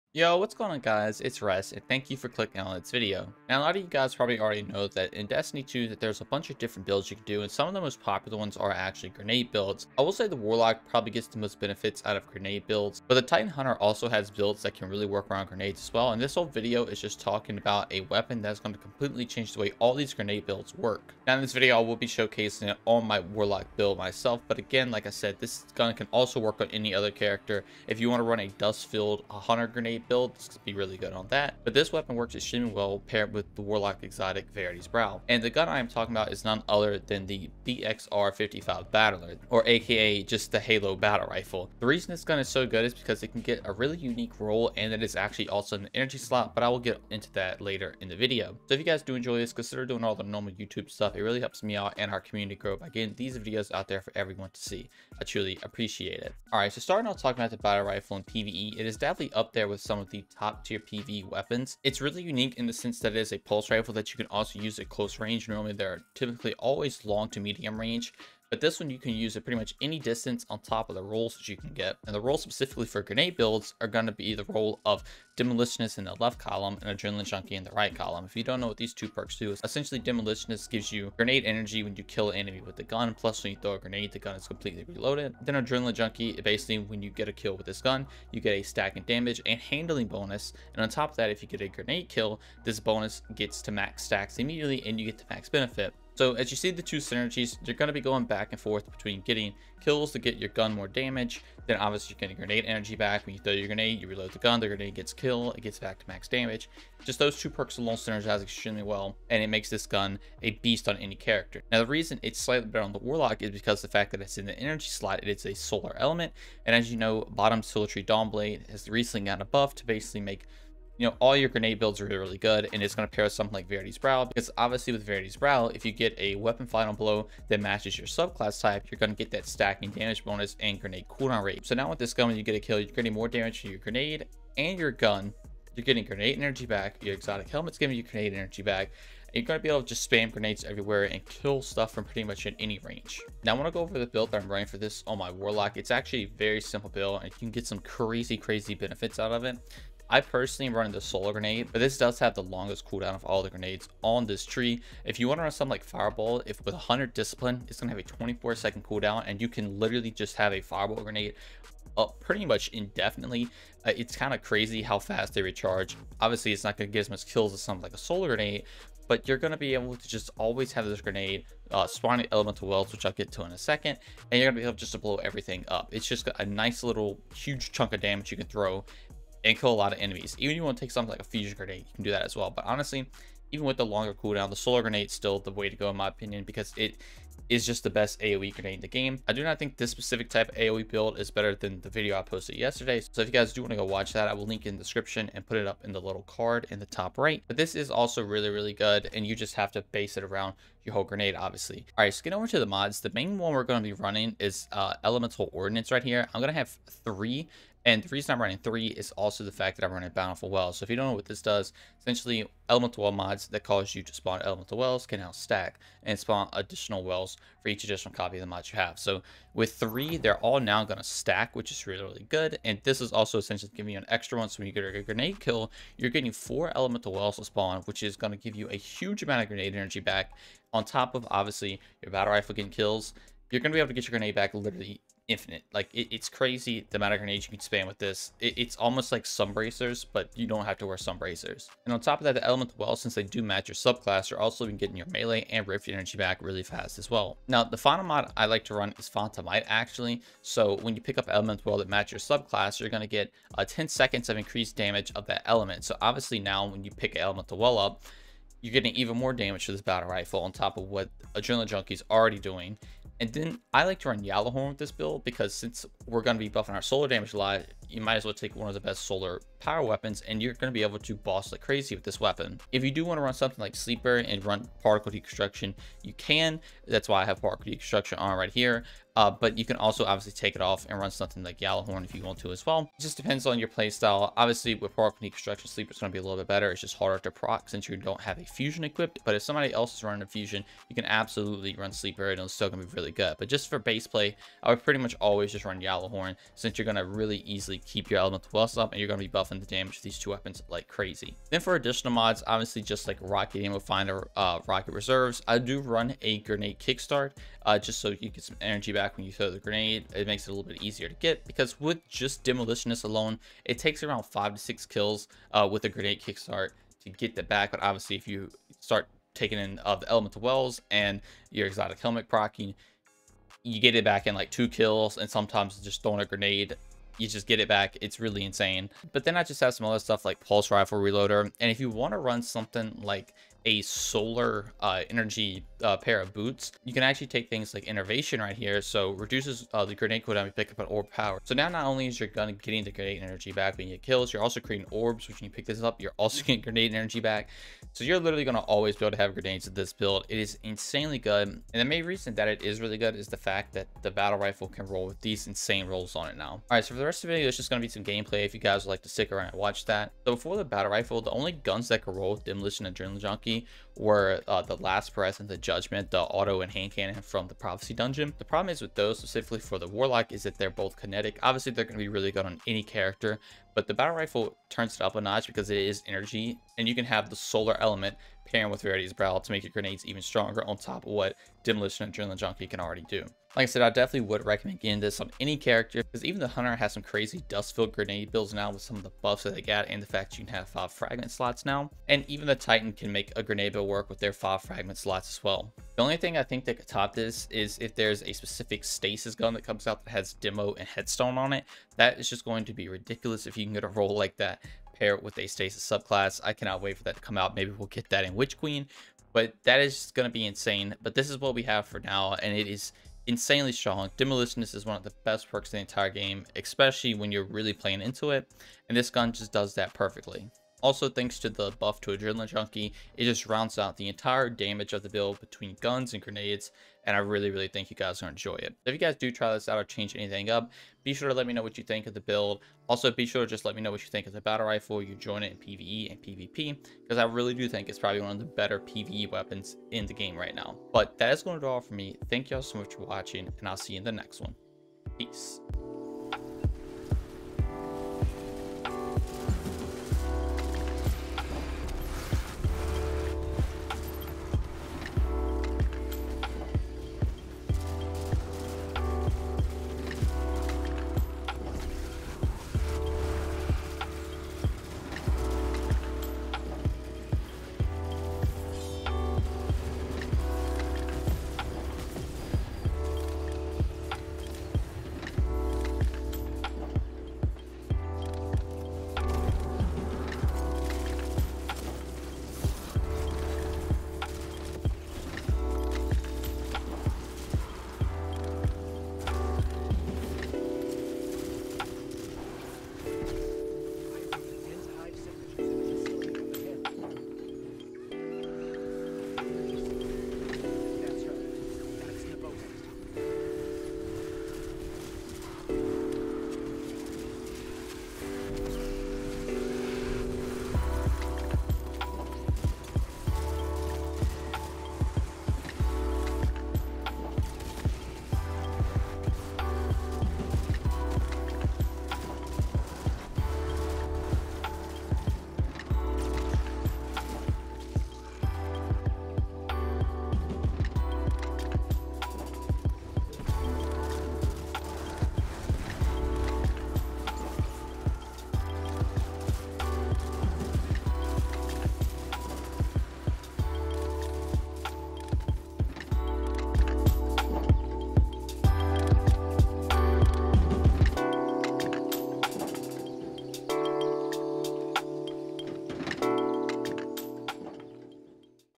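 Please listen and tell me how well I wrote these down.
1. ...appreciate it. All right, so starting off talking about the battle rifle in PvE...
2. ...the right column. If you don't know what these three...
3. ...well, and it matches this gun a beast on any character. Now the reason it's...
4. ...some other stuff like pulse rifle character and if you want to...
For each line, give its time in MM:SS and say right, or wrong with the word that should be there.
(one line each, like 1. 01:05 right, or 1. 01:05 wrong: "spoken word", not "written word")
1. 00:55 right
2. 01:17 wrong: "two", not "three"
3. 01:48 wrong: "makes", not "matches"
4. 05:29 wrong: "reloader", not "character".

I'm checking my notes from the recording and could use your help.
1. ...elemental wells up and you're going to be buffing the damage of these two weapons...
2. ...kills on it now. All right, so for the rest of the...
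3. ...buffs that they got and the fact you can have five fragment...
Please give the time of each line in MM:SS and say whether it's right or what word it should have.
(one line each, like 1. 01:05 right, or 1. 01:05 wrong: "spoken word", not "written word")
1. 04:58 right
2. 05:55 wrong: "rolls", not "kills"
3. 06:29 right.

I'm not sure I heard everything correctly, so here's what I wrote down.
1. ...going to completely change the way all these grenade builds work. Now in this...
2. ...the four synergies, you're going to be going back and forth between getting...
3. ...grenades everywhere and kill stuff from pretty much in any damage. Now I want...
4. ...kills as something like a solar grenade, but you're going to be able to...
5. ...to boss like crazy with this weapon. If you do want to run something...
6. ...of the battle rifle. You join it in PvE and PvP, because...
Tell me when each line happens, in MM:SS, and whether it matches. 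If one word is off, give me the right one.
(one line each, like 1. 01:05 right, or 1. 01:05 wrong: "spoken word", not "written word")
1. 00:18 right
2. 01:36 wrong: "two", not "four"
3. 02:20 wrong: "range", not "damage"
4. 02:47 right
5. 04:30 right
6. 07:14 right.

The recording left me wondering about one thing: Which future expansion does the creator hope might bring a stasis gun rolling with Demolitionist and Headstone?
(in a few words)
Witch Queen.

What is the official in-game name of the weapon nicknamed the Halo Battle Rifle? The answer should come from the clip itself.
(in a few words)
BXR-55 Battler.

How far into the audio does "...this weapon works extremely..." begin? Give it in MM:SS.
00:31.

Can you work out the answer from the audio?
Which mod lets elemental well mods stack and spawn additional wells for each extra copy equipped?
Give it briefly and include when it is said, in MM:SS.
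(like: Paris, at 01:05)
Bountiful Wells, at 03:30.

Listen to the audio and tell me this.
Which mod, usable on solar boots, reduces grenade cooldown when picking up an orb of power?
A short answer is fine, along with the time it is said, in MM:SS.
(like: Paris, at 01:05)
Innervation, at 05:37.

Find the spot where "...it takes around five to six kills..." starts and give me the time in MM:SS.
05:13.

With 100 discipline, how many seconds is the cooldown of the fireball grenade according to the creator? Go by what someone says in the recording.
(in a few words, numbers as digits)
24.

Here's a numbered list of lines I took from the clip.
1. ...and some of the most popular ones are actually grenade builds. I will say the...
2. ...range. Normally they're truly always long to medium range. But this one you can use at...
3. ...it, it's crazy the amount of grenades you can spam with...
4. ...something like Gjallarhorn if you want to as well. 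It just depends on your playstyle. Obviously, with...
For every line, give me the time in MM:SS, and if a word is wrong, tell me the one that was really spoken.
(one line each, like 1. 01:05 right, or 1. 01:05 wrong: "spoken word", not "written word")
1. 00:07 right
2. 01:05 wrong: "typically", not "truly"
3. 03:55 right
4. 04:41 right.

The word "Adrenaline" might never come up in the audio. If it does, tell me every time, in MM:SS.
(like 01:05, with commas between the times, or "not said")
01:16, 01:25, 04:21, 06:02, 06:22, 07:02.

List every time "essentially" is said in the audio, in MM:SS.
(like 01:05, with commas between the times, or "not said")
01:19, 03:31, 03:43.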